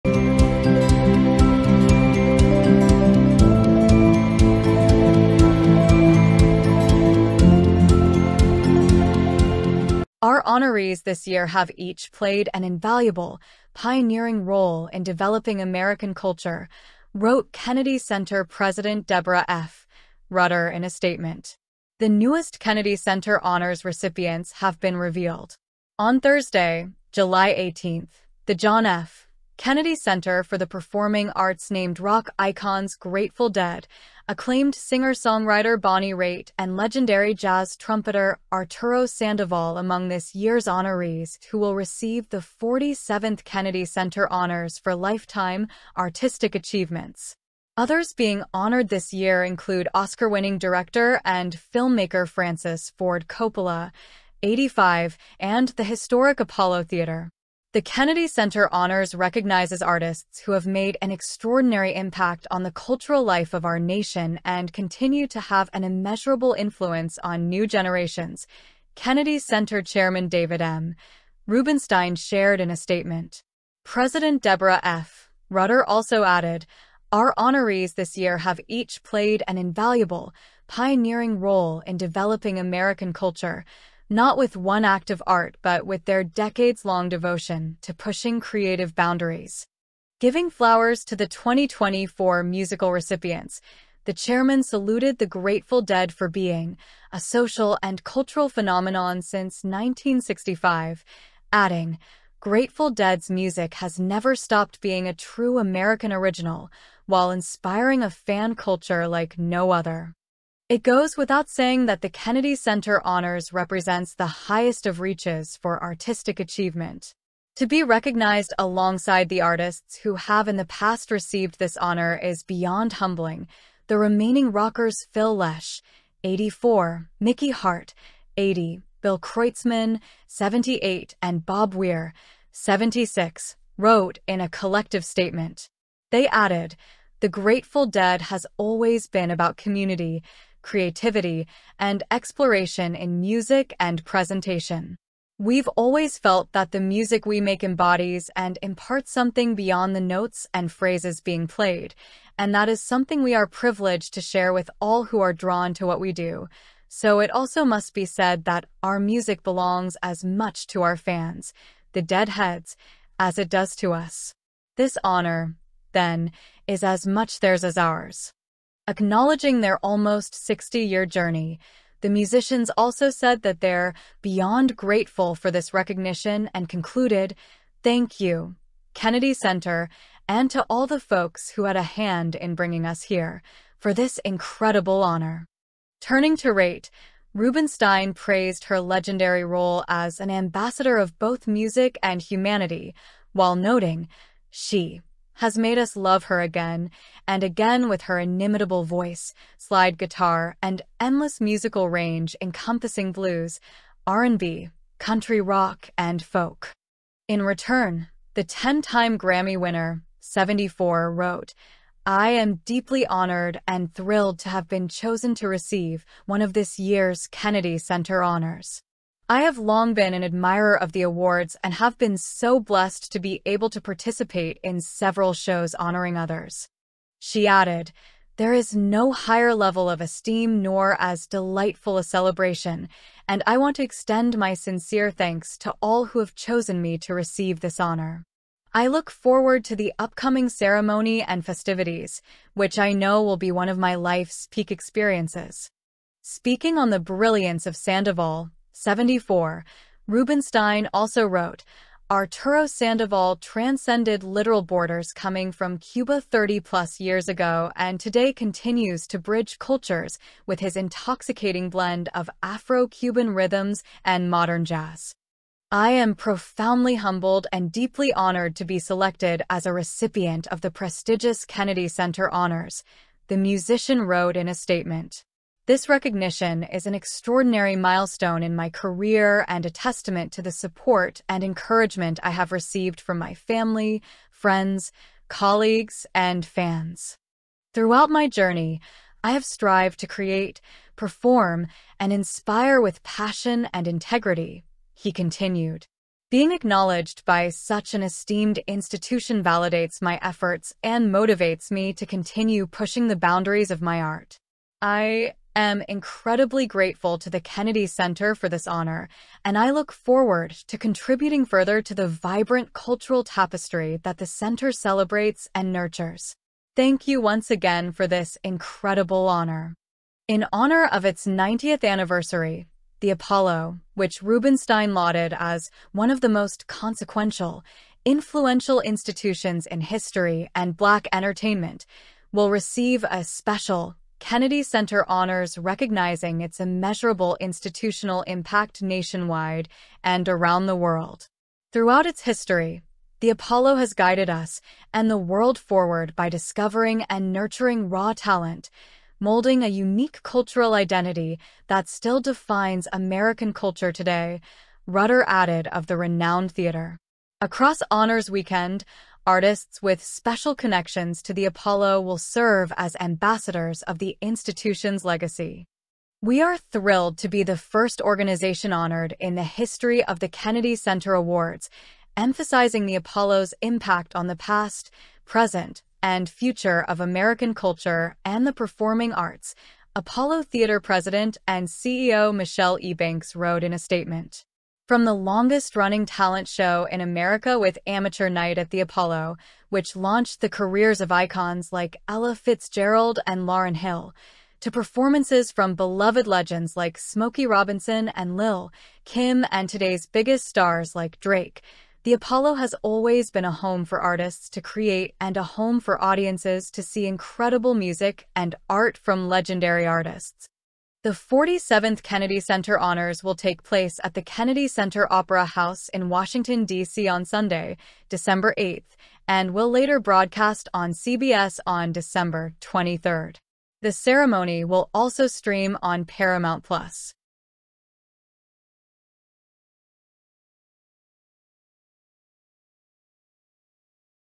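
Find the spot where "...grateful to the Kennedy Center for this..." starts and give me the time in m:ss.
5:06.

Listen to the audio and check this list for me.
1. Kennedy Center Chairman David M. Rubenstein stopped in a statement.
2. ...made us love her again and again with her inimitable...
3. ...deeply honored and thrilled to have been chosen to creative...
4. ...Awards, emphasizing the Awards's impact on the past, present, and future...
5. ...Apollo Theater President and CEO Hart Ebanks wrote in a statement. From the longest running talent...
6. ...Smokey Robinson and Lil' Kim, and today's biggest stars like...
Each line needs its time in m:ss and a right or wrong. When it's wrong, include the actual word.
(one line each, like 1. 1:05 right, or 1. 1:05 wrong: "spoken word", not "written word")
1. 1:08 wrong: "shared", not "stopped"
2. 3:15 right
3. 3:32 wrong: "receive", not "creative"
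4. 6:11 wrong: "Apollo", not "Awards"
5. 6:19 wrong: "Michelle", not "Hart"
6. 6:36 right.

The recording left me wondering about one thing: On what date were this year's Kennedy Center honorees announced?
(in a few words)
July 18.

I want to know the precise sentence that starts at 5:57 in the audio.
Across Honors Weekend, Artists with special connections to the Apollo will serve as ambassadors of the institution's legacy.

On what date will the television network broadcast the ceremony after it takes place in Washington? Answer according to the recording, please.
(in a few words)
December 23.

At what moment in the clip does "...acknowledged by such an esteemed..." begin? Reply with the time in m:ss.
4:56.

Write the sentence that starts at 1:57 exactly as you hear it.
To be recognized alongside the artists who have in the past received this honor is beyond humbling.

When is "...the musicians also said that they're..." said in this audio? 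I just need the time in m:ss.
2:52.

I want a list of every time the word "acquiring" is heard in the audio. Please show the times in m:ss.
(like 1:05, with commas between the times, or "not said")
not said.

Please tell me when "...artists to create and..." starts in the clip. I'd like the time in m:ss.
6:44.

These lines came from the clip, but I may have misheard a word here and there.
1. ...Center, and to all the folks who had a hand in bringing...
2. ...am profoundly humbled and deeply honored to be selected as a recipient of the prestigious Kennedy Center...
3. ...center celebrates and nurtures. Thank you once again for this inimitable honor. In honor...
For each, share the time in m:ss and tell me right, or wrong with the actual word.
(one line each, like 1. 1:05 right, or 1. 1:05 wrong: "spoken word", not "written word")
1. 2:59 right
2. 4:25 right
3. 5:14 wrong: "incredible", not "inimitable".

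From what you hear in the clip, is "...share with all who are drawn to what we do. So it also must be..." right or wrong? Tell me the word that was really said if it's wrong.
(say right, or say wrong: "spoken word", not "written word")
right.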